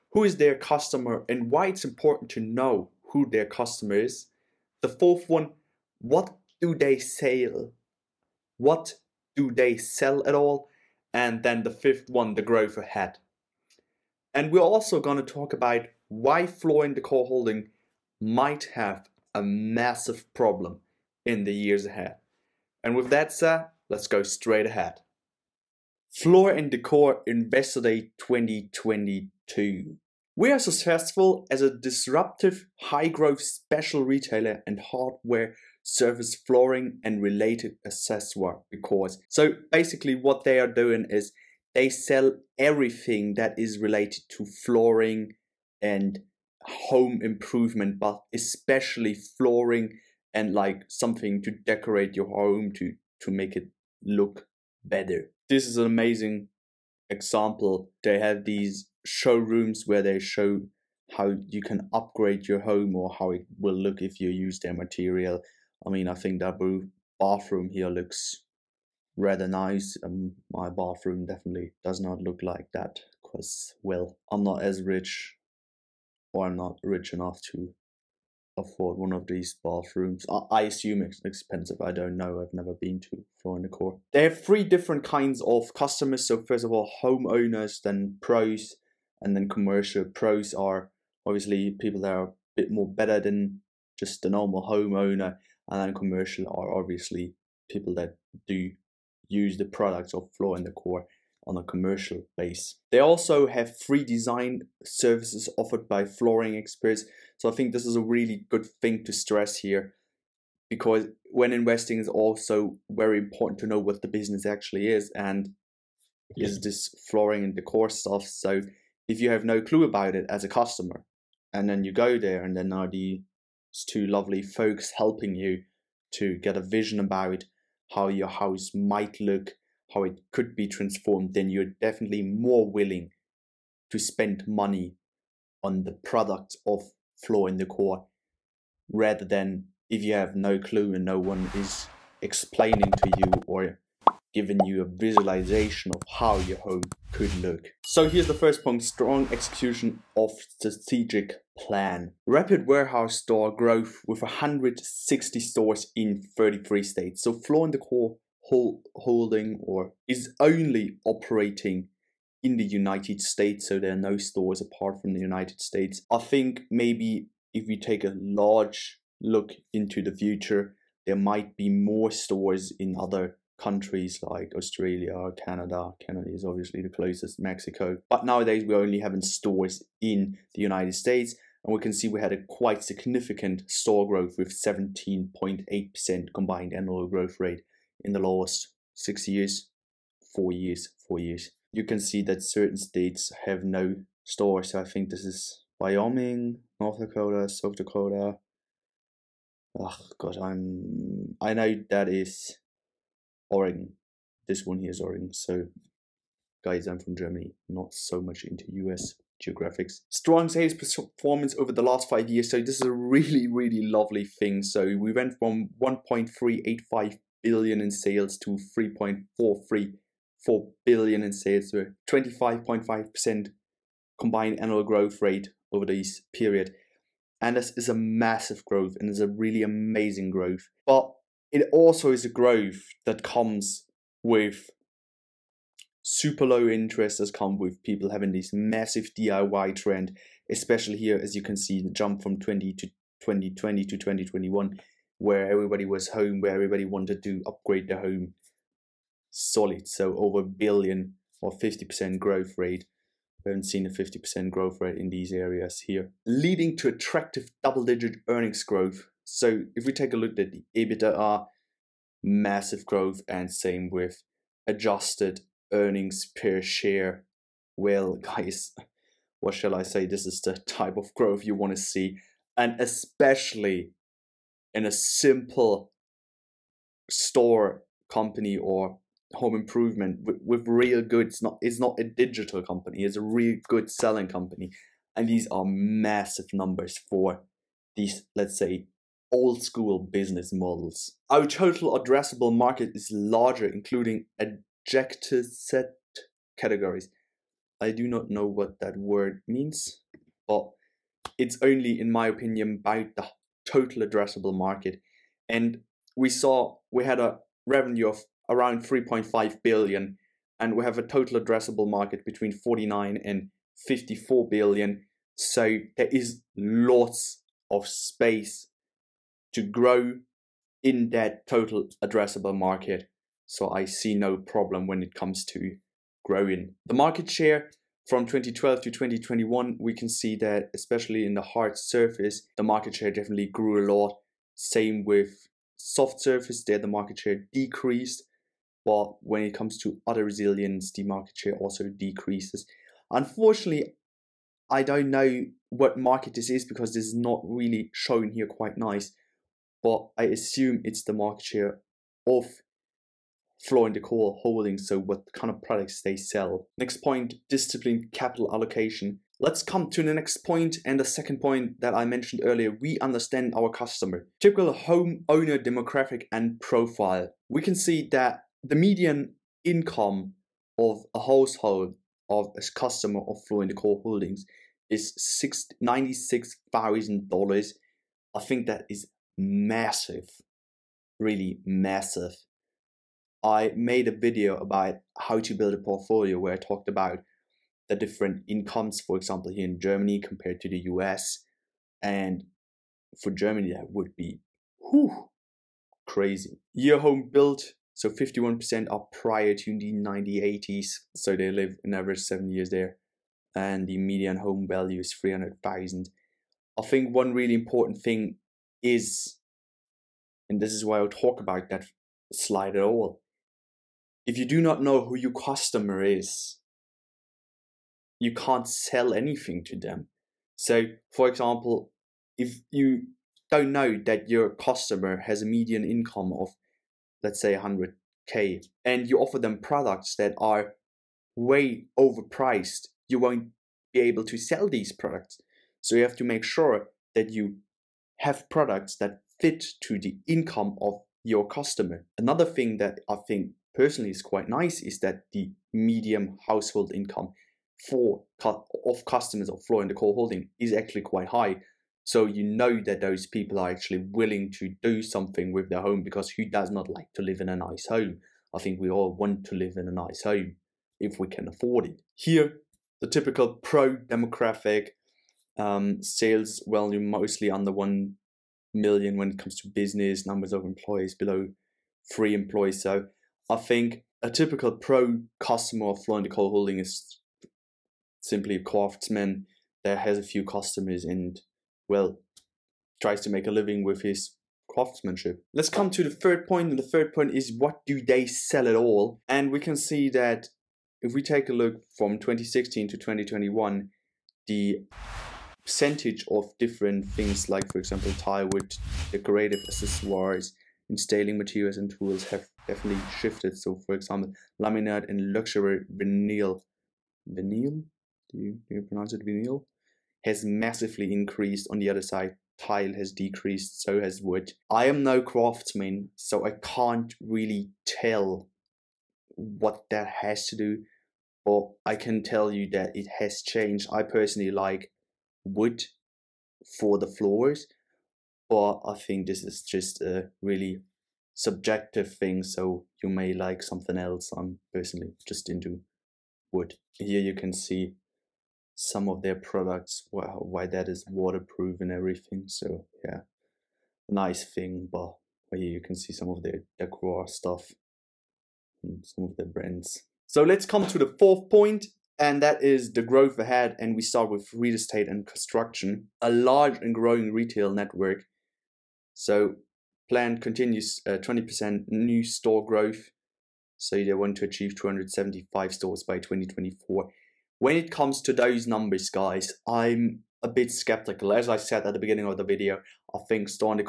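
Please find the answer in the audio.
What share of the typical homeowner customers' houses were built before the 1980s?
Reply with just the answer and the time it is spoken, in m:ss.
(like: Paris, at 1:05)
51%, at 6:38.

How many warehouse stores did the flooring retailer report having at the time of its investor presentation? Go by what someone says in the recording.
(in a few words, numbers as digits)
160.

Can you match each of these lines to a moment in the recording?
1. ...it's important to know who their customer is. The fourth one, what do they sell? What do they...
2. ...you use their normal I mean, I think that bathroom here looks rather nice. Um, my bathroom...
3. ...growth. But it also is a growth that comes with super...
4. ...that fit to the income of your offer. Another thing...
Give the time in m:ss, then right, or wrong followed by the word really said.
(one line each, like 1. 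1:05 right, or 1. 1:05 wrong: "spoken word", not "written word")
1. 0:01 right
2. 1:04 wrong: "material", not "normal"
3. 3:50 right
4. 7:18 wrong: "customer", not "offer".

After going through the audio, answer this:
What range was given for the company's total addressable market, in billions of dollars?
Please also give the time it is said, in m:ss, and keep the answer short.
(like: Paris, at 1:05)
49 to 54 billion, at 5:12.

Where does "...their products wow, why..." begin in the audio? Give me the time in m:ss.
8:59.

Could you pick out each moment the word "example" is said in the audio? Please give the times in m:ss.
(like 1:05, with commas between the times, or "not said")
0:57, 6:29, 7:01, 8:17, 8:23.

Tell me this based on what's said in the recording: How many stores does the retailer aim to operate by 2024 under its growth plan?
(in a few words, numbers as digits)
275.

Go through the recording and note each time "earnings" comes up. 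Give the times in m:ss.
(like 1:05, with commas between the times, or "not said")
4:18, 4:25.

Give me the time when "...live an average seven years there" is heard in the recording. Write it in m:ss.
6:41.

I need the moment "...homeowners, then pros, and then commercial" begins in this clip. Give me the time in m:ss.
1:27.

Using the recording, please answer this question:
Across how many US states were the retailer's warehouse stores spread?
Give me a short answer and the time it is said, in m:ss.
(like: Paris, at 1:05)
33, at 2:36.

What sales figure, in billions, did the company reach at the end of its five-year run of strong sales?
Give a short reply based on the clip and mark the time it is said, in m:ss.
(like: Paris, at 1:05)
3.434 billion, at 3:38.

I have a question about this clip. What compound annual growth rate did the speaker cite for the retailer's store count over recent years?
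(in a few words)
17.8%.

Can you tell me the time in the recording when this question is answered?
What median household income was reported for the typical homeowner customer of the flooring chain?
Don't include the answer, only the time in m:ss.
6:15.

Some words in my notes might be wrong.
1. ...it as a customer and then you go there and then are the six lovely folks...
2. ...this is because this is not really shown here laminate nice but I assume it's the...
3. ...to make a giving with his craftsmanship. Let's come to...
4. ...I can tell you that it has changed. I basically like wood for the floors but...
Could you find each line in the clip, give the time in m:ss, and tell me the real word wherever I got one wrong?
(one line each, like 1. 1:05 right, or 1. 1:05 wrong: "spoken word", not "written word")
1. 2:00 wrong: "two", not "six"
2. 5:46 wrong: "quite", not "laminate"
3. 8:03 wrong: "living", not "giving"
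4. 8:41 wrong: "personally", not "basically".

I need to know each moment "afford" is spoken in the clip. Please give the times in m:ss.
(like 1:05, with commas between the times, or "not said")
1:18, 7:41.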